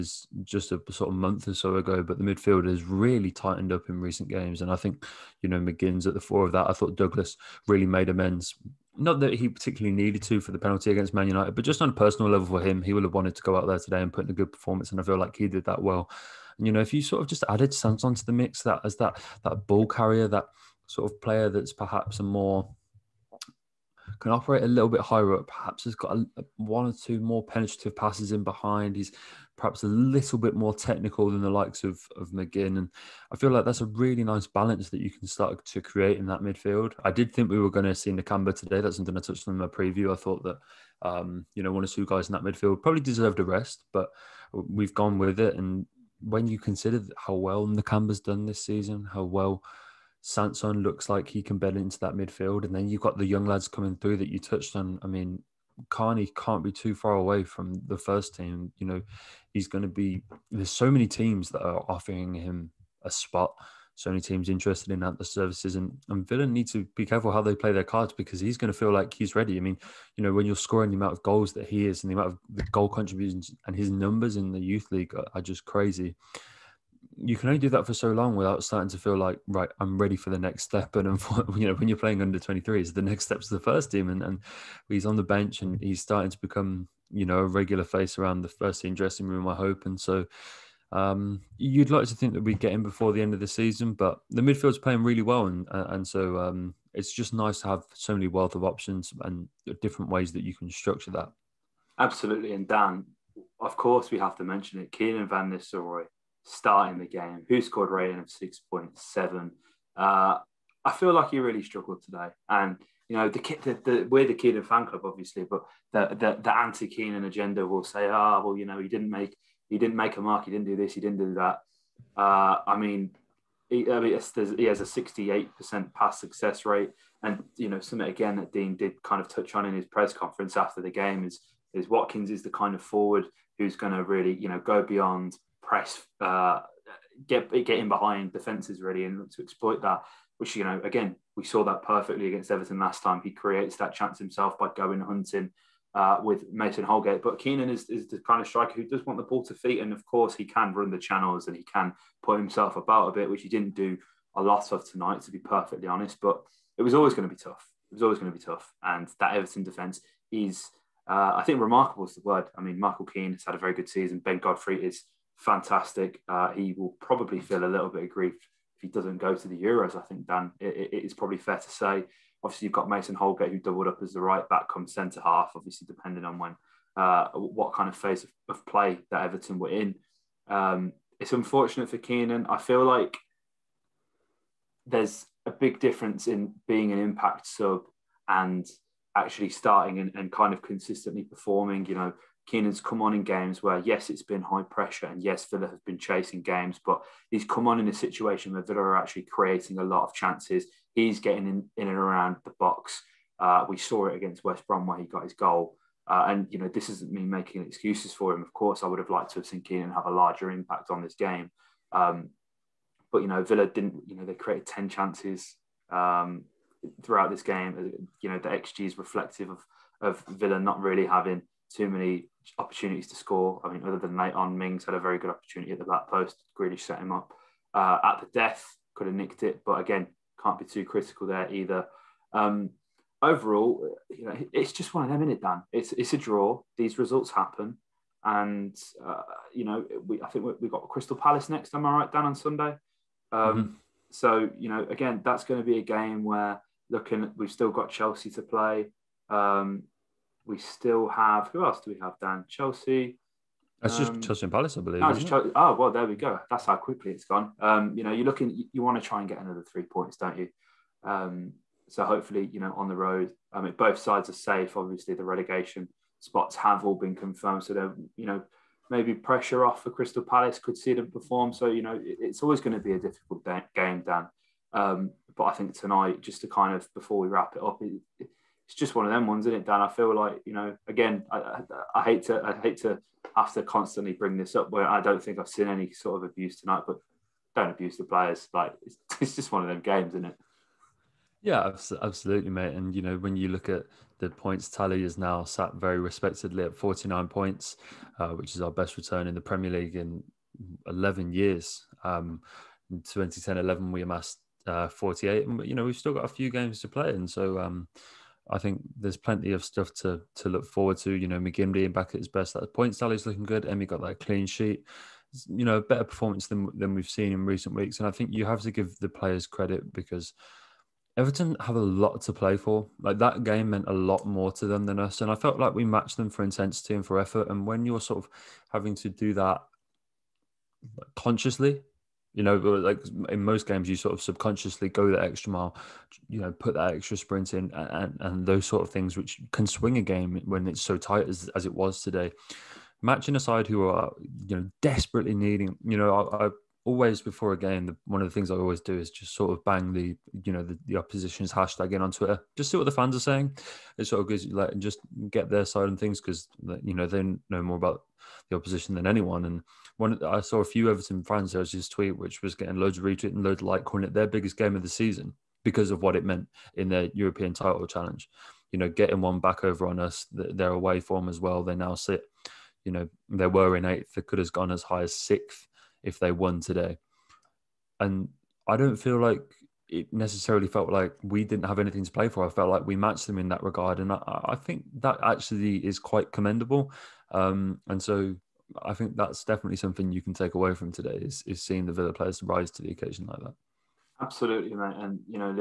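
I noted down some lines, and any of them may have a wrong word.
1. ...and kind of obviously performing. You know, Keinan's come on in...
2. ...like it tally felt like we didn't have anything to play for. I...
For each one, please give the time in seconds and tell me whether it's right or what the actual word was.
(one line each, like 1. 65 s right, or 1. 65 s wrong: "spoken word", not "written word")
1. 190 s wrong: "consistently", not "obviously"
2. 379 s wrong: "necessarily", not "tally".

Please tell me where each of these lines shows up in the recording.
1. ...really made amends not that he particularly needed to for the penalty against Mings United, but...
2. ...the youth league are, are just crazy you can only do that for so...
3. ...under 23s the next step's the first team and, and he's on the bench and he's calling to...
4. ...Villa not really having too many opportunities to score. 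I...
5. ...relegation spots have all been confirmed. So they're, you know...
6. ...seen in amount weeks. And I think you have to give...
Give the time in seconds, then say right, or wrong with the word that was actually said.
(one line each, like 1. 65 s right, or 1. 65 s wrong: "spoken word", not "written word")
1. 7 s wrong: "Man", not "Mings"
2. 74 s right
3. 82 s wrong: "starting", not "calling"
4. 220 s right
5. 265 s right
6. 317 s wrong: "recent", not "amount".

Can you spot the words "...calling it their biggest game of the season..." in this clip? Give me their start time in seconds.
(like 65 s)
363 s.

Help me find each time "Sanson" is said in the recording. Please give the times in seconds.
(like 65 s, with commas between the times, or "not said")
17 s, 50 s.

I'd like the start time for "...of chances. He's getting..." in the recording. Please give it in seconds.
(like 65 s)
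200 s.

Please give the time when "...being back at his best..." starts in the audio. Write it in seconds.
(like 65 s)
311 s.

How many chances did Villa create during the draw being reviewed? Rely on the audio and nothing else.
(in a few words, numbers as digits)
10.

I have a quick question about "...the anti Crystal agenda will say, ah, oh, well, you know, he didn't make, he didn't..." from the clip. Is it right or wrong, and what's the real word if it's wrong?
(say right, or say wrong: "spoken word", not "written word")
wrong: "Keinan", not "Crystal".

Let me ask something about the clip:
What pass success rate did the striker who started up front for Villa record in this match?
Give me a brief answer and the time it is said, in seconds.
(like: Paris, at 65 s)
68%, at 124 s.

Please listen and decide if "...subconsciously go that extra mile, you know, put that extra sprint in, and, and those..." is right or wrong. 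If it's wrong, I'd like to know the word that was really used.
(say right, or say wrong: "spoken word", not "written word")
right.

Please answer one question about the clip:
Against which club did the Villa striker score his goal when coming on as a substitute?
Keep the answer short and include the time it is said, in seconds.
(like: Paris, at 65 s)
West Brom, at 204 s.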